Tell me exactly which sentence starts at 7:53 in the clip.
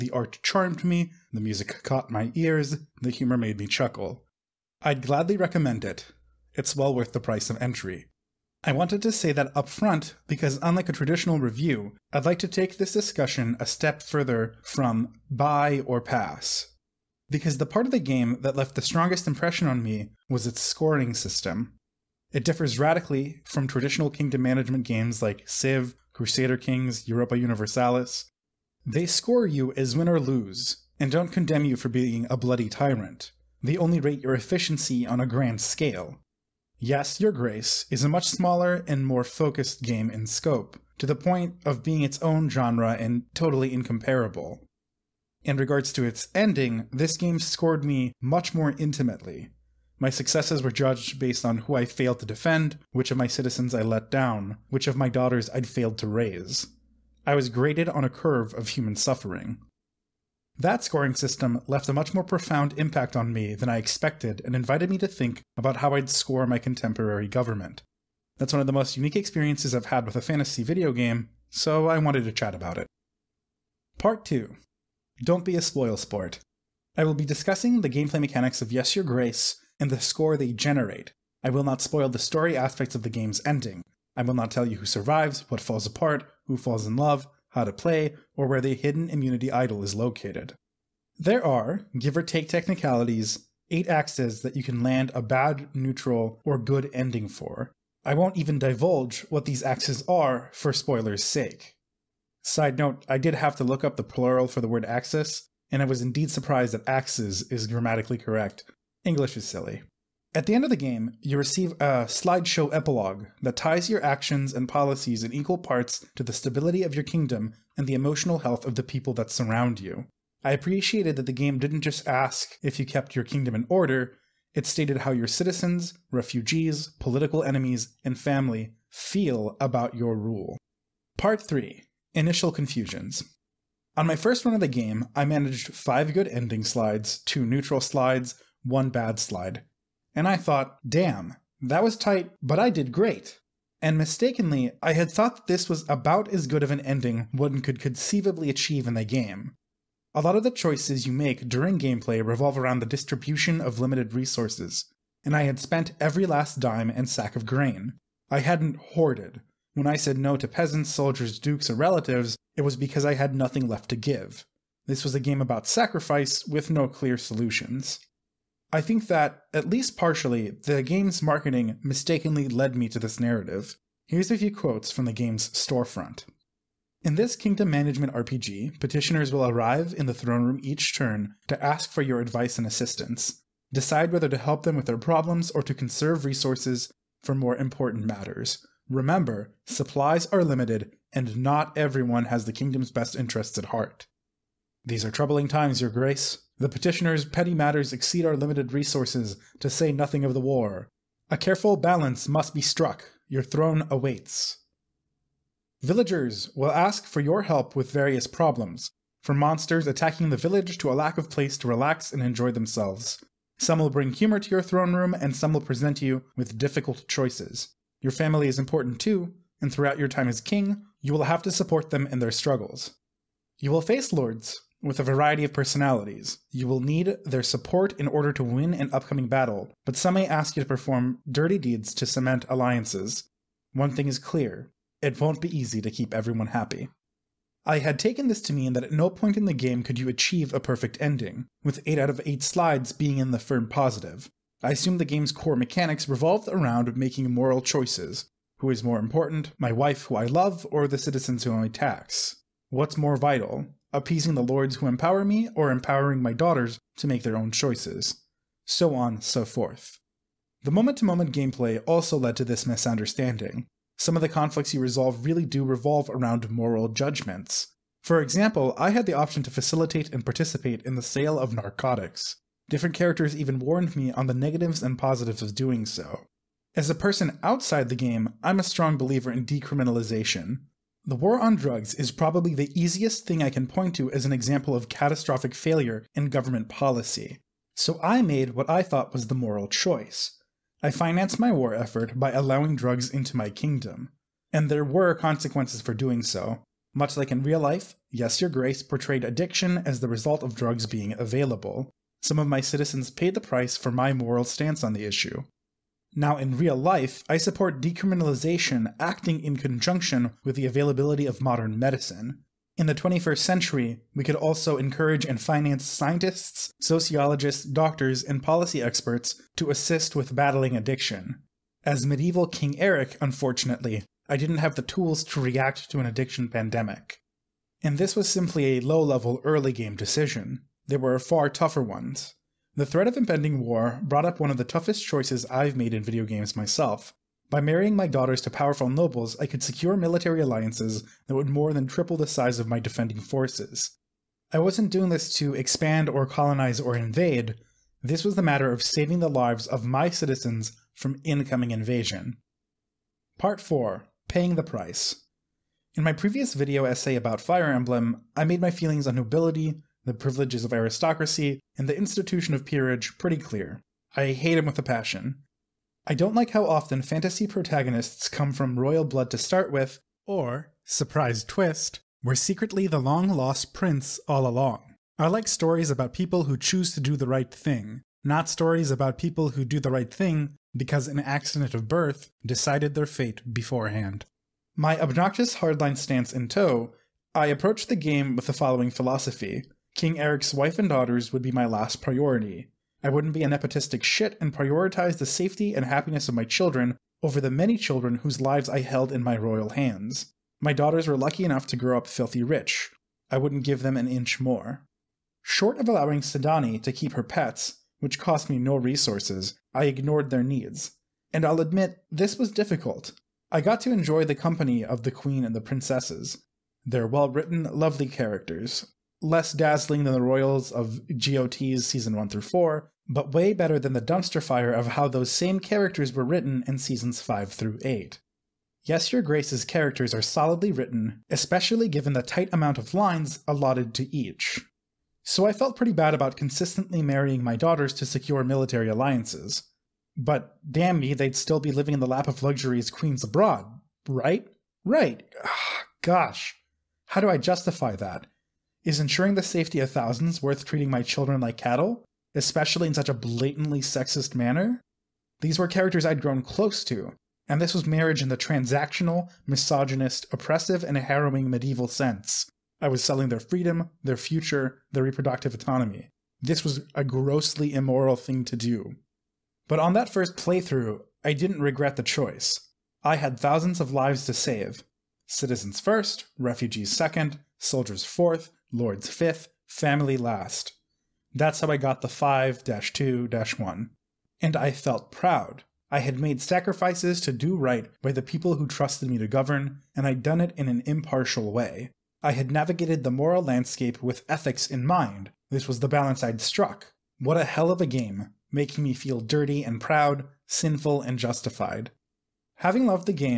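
I had thousands of lives to save.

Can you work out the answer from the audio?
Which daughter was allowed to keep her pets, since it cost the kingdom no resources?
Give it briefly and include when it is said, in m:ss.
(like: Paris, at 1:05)
Sedani, at 6:46.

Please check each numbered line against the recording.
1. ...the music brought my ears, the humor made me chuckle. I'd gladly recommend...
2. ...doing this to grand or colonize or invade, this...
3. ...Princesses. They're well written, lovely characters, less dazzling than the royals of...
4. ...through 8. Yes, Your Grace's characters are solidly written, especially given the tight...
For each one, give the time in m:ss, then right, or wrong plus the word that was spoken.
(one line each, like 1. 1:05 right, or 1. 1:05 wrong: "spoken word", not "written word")
1. 0:01 wrong: "caught", not "brought"
2. 5:44 wrong: "expand", not "grand"
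3. 6:55 right
4. 7:07 right.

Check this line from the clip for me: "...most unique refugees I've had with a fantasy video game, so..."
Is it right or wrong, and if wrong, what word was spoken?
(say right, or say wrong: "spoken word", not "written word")
wrong: "experiences", not "refugees".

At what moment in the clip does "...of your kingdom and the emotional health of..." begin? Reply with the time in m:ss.
1:56.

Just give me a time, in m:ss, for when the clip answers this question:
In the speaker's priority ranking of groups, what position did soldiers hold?
7:58.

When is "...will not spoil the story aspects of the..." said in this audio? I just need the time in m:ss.
1:21.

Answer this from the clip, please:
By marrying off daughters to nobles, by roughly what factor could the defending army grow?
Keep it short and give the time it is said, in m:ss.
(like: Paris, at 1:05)
Triple, at 5:41.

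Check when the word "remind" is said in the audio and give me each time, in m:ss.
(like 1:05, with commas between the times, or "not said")
not said.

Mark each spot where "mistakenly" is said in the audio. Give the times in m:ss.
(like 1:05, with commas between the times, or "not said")
2:23, 2:51.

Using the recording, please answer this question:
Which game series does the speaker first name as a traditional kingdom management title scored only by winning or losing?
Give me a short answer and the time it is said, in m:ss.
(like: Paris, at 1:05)
Civ, at 0:25.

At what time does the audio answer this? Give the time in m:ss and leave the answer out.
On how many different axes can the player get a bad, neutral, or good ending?
1:33.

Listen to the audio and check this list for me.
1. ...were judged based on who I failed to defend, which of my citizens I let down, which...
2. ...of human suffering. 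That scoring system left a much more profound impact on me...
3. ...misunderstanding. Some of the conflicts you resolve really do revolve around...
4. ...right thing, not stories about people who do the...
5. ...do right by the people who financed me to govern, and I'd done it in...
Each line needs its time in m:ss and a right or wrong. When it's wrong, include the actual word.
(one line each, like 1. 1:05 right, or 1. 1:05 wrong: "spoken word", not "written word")
1. 0:50 right
2. 0:58 right
3. 4:22 right
4. 6:17 right
5. 8:07 wrong: "trusted", not "financed".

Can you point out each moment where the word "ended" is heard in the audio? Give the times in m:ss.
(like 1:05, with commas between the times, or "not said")
not said.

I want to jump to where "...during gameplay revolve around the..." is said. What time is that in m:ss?
2:31.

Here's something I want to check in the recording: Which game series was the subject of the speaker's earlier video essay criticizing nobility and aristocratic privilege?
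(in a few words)
Fire Emblem.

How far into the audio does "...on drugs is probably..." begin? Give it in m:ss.
4:41.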